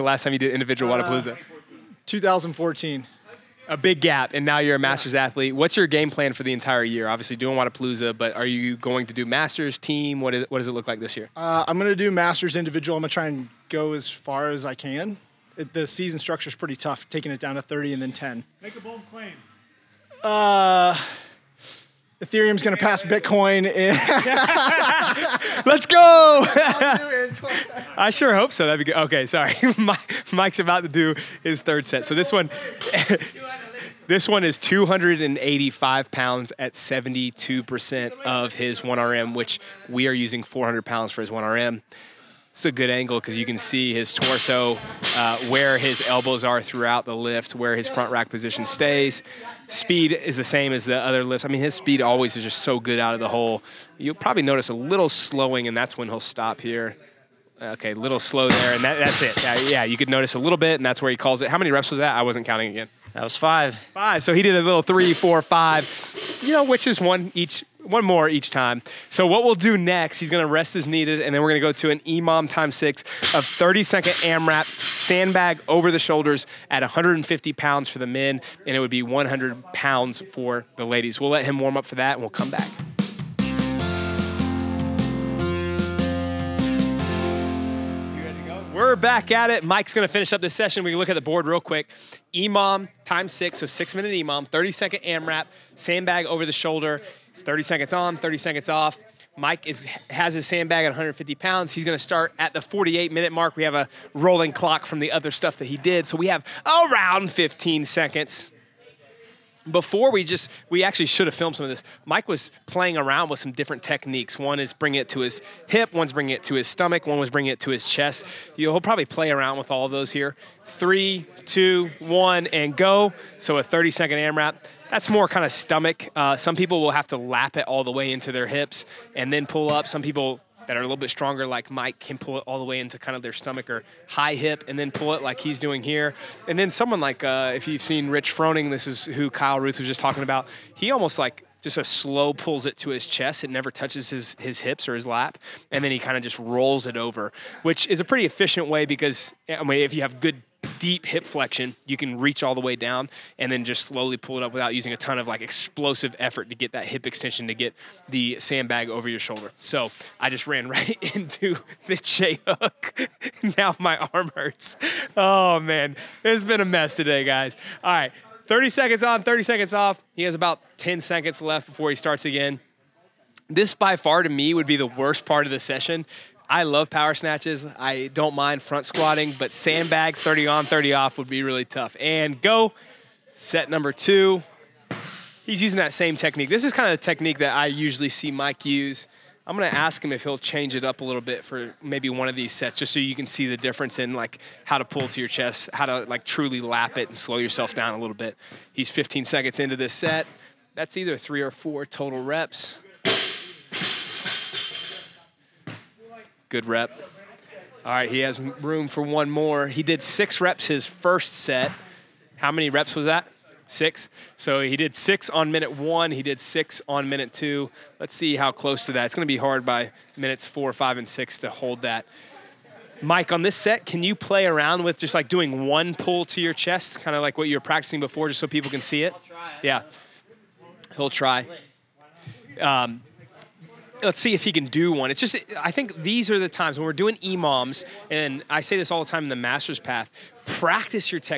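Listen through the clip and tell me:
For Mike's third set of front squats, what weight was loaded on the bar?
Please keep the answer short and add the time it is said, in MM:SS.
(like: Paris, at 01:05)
285 pounds, at 00:34.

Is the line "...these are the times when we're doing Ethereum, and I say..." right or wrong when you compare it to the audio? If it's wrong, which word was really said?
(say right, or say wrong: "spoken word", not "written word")
wrong: "EMOMs", not "Ethereum".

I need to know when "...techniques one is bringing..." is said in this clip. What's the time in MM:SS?
01:53.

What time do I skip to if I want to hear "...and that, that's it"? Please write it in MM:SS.
00:58.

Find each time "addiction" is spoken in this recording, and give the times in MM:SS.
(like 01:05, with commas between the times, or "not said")
not said.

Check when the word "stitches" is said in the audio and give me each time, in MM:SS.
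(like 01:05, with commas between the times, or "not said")
not said.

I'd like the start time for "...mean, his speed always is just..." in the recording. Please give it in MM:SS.
00:51.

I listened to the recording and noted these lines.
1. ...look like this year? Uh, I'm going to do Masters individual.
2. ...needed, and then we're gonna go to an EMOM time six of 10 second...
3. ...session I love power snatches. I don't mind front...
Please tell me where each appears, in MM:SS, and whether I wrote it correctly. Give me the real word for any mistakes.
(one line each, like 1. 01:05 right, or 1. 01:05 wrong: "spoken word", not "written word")
1. 00:10 right
2. 01:10 wrong: "30", not "10"
3. 02:55 right.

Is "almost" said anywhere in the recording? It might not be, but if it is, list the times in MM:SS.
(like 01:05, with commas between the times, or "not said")
02:20.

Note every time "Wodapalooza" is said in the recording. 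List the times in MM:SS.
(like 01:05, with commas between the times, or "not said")
00:01, 00:07.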